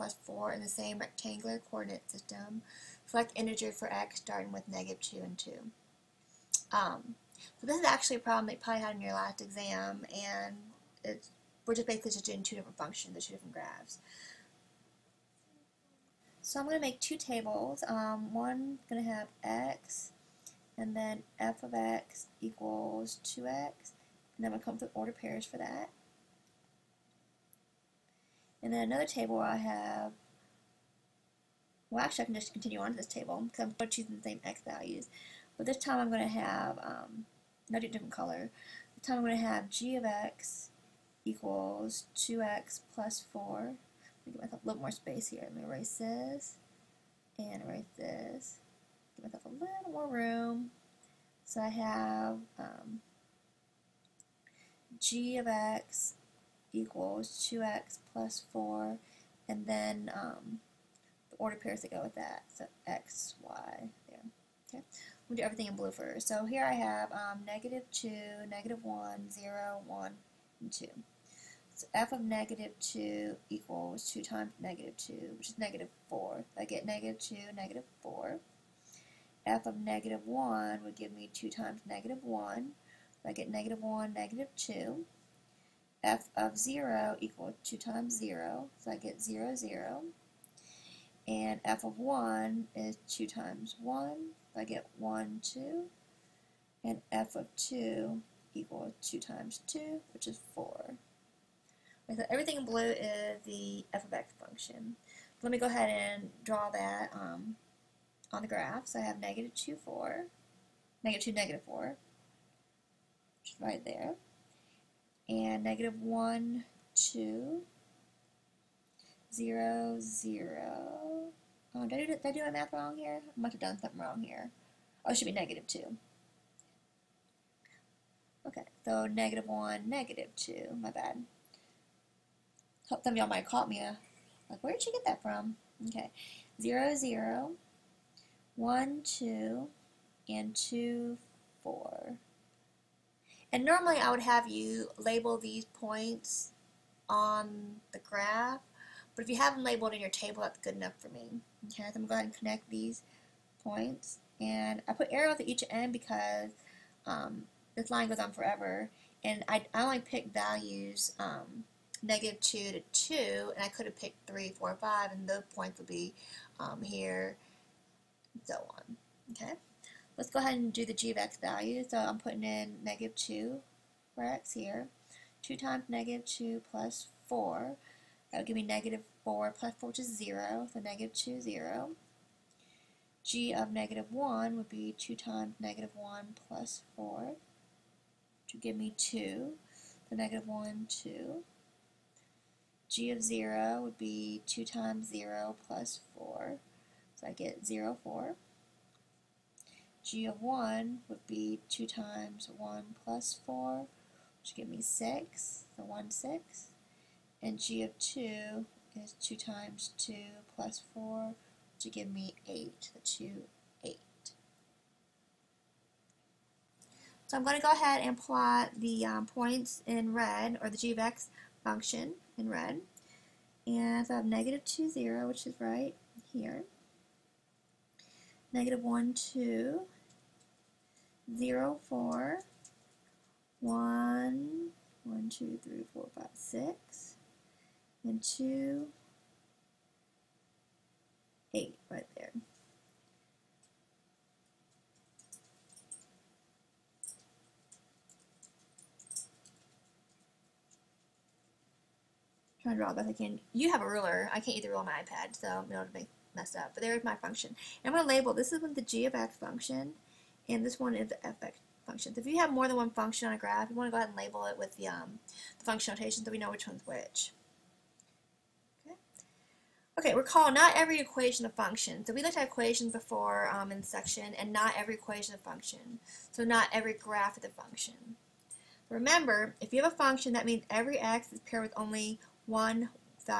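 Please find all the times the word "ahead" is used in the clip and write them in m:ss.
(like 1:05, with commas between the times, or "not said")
1:45, 2:32, 2:50, 3:37, 4:23.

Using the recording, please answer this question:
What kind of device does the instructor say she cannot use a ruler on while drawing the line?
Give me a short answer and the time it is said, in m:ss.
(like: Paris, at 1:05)
iPad, at 4:14.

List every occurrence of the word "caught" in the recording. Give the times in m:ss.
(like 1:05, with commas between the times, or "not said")
2:13.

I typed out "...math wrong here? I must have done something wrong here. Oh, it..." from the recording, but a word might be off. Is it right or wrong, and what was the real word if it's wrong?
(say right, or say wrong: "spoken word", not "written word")
right.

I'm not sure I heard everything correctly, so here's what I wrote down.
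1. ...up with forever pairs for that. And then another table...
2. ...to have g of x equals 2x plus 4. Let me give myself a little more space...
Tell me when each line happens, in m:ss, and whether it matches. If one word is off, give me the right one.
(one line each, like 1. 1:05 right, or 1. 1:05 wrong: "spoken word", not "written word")
1. 0:24 wrong: "order", not "forever"
2. 0:39 right.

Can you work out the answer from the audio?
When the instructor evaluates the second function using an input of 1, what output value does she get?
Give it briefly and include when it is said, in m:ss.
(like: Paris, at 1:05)
6, at 3:24.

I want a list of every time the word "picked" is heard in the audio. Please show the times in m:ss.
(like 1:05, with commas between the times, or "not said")
2:39, 2:43.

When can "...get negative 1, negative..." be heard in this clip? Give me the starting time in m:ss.
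1:23.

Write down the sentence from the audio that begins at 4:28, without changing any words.
Okay, okay recall, not every equation a function.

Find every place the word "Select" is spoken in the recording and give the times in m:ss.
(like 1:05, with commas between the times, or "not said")
0:03.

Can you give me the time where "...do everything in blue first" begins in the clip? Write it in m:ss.
1:05.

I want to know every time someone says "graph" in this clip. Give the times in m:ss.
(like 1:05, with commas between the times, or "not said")
0:13, 1:48, 2:27, 4:23, 4:36.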